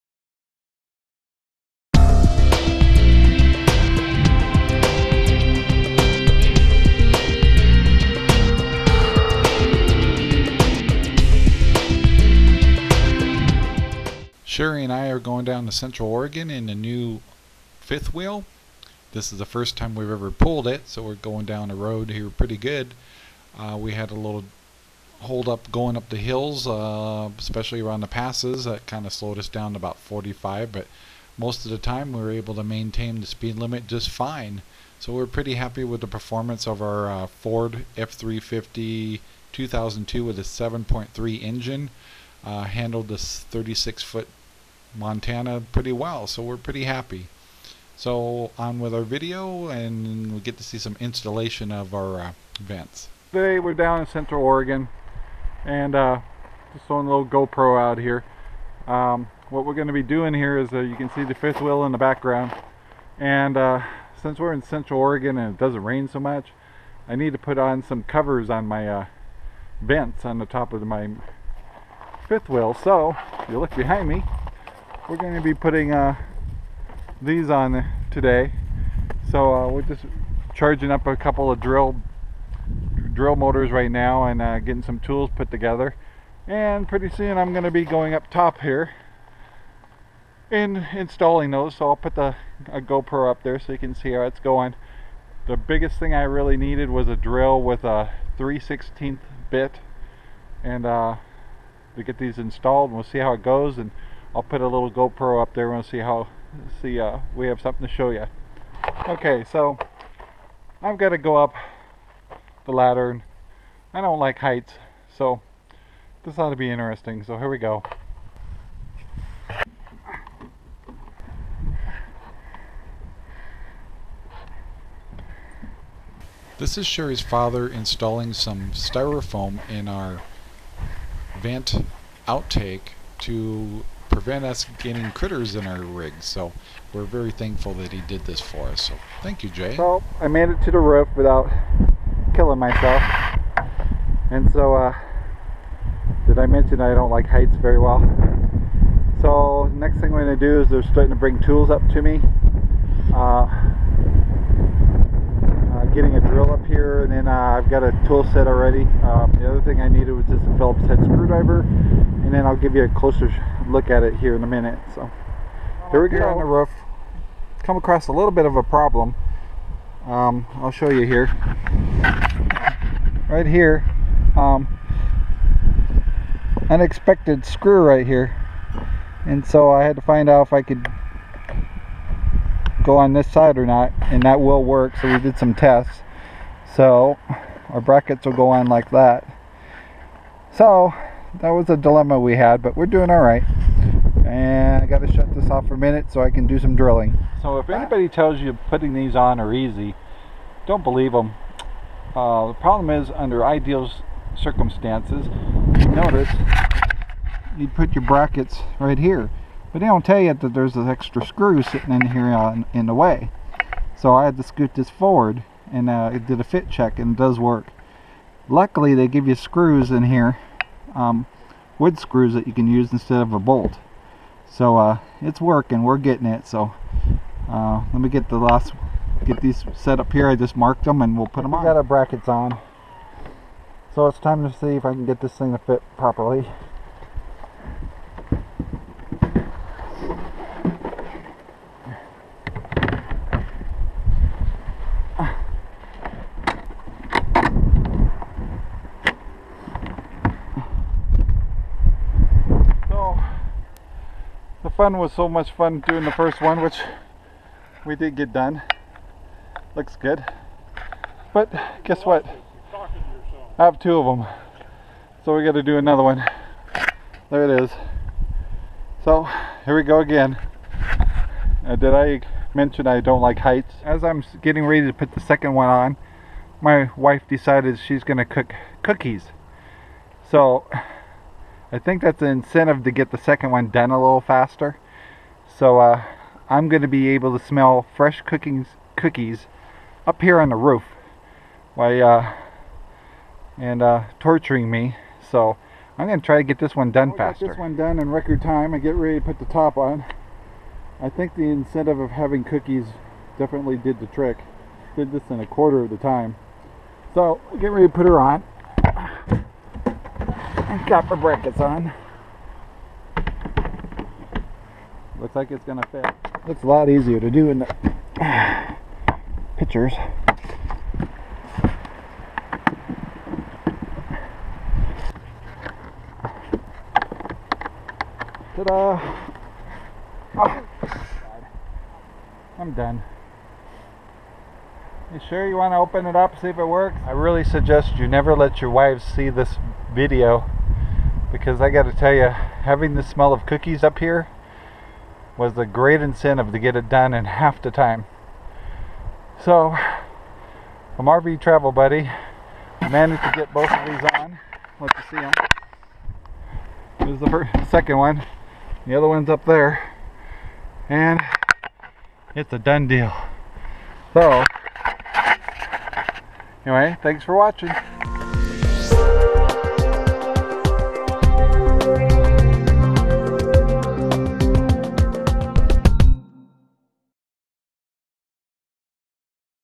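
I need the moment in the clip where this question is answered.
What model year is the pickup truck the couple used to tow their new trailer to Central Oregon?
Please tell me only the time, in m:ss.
0:39.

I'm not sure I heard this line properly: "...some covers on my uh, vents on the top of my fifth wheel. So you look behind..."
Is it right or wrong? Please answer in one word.
right.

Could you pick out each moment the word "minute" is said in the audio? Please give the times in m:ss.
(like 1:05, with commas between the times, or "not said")
2:44, 3:15.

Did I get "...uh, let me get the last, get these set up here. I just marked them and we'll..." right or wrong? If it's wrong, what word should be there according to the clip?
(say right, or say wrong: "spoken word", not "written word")
right.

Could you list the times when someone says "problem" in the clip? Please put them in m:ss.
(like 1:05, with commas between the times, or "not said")
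2:48, 3:22.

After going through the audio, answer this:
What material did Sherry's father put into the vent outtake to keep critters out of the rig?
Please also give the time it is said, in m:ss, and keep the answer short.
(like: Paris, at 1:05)
styrofoam, at 2:08.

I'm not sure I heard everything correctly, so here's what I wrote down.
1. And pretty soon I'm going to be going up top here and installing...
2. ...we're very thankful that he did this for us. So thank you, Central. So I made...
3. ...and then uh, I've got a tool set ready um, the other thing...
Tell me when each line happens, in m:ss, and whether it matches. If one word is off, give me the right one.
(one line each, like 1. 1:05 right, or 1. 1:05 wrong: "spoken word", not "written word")
1. 1:26 right
2. 2:16 wrong: "Jay", not "Central"
3. 2:37 wrong: "already", not "ready".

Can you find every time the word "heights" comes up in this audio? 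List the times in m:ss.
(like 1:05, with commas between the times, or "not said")
1:54, 2:27, 4:33.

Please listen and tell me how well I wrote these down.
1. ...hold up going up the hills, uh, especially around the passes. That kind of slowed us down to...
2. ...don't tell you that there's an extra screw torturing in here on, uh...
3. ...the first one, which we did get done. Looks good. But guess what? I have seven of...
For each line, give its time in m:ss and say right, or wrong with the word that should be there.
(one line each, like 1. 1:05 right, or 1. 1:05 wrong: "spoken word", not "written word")
1. 0:25 right
2. 3:29 wrong: "sitting", not "torturing"
3. 4:16 wrong: "two", not "seven".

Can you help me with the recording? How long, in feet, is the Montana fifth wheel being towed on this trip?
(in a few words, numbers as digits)
36 feet.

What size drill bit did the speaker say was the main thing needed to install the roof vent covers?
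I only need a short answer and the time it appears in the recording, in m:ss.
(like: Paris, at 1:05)
3/16, at 1:38.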